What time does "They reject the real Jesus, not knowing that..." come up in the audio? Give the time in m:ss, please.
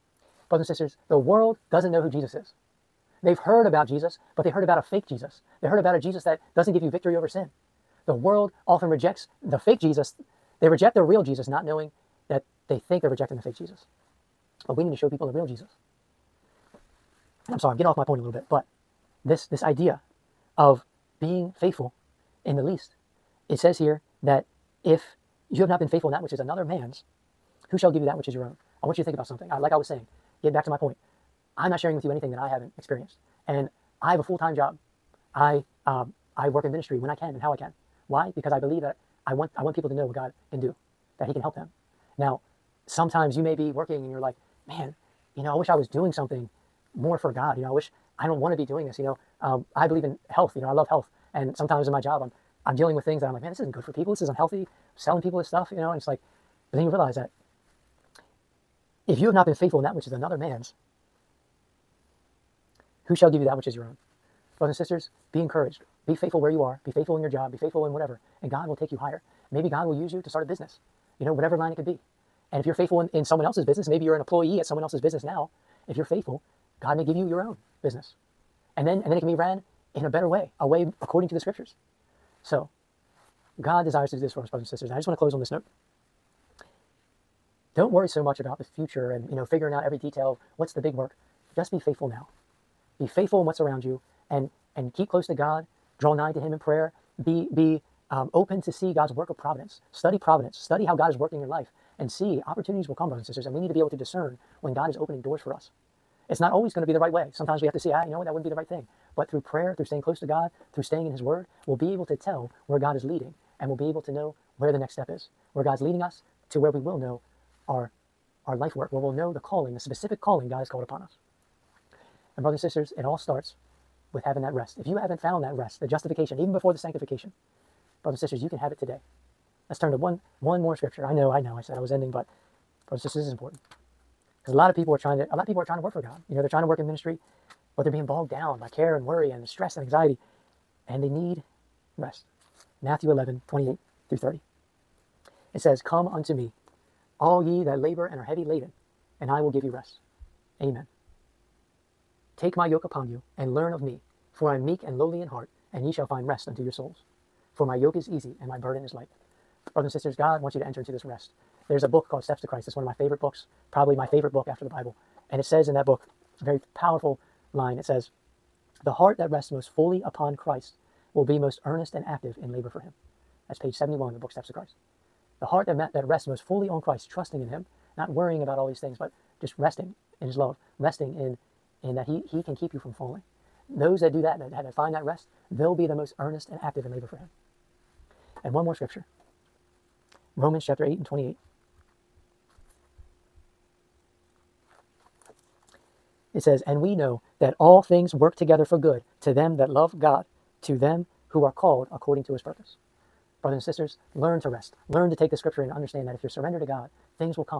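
0:10.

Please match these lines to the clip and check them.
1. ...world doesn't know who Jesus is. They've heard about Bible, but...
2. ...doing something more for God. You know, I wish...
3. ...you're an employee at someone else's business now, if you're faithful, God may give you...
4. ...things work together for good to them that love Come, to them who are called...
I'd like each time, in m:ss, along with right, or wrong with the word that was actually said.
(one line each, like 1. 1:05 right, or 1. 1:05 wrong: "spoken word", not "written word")
1. 0:01 wrong: "Jesus", not "Bible"
2. 0:45 right
3. 1:14 right
4. 3:17 wrong: "God", not "Come".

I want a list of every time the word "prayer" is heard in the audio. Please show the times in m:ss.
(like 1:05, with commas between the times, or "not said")
1:36, 1:49.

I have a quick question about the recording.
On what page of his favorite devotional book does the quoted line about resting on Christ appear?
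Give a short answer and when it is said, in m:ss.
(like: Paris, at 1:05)
71, at 2:53.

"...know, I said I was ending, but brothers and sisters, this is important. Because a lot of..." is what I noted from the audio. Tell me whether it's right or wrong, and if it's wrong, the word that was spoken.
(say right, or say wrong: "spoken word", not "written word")
right.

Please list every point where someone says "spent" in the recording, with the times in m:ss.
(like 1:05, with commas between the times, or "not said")
not said.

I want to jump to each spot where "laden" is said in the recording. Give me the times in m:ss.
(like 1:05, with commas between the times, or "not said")
2:28.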